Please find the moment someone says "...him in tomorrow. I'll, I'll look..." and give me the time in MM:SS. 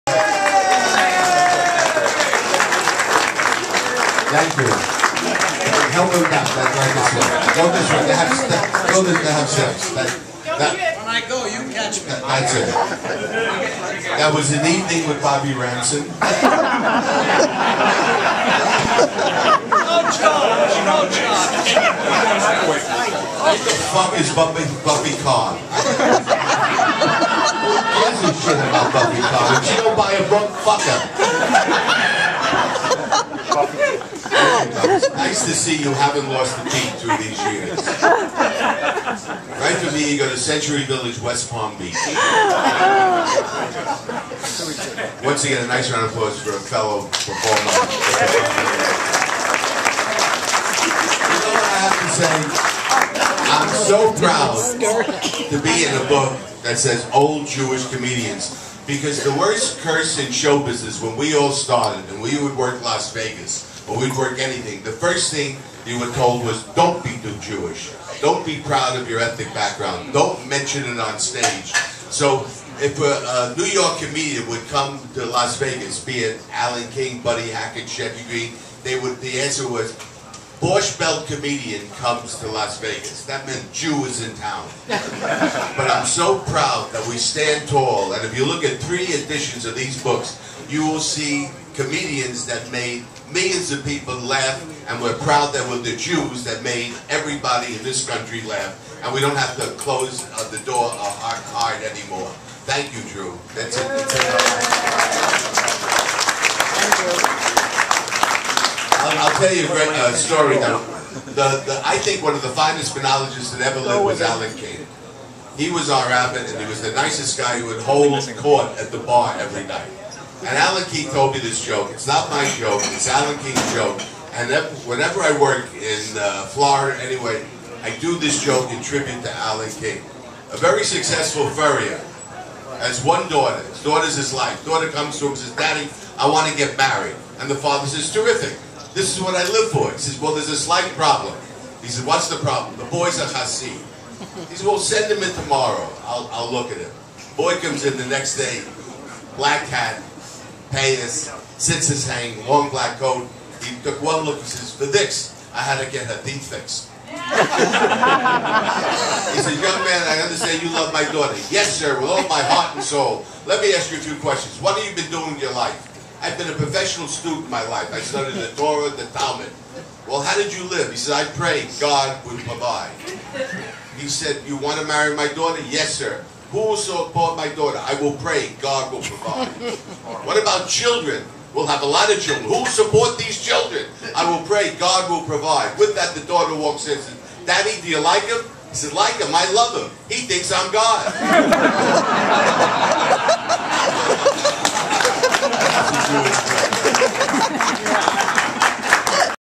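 02:25.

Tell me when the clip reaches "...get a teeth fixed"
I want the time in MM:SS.
02:35.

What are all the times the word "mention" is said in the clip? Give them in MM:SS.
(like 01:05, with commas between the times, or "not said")
01:10.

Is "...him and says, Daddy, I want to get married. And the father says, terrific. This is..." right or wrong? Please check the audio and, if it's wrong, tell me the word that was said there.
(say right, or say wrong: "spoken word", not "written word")
right.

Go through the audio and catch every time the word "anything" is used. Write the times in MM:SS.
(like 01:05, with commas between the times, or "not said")
01:04.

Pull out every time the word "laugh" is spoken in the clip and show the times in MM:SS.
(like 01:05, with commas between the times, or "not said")
01:34, 01:38.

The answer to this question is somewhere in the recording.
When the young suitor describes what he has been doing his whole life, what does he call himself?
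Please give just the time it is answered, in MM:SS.
02:46.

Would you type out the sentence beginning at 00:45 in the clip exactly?
Once again, a nice round of applause for a fellow performer.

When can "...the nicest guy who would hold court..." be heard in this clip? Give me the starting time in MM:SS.
01:56.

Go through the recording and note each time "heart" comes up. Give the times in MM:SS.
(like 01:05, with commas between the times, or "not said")
01:41, 02:42.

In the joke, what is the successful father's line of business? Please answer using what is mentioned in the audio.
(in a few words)
Furrier.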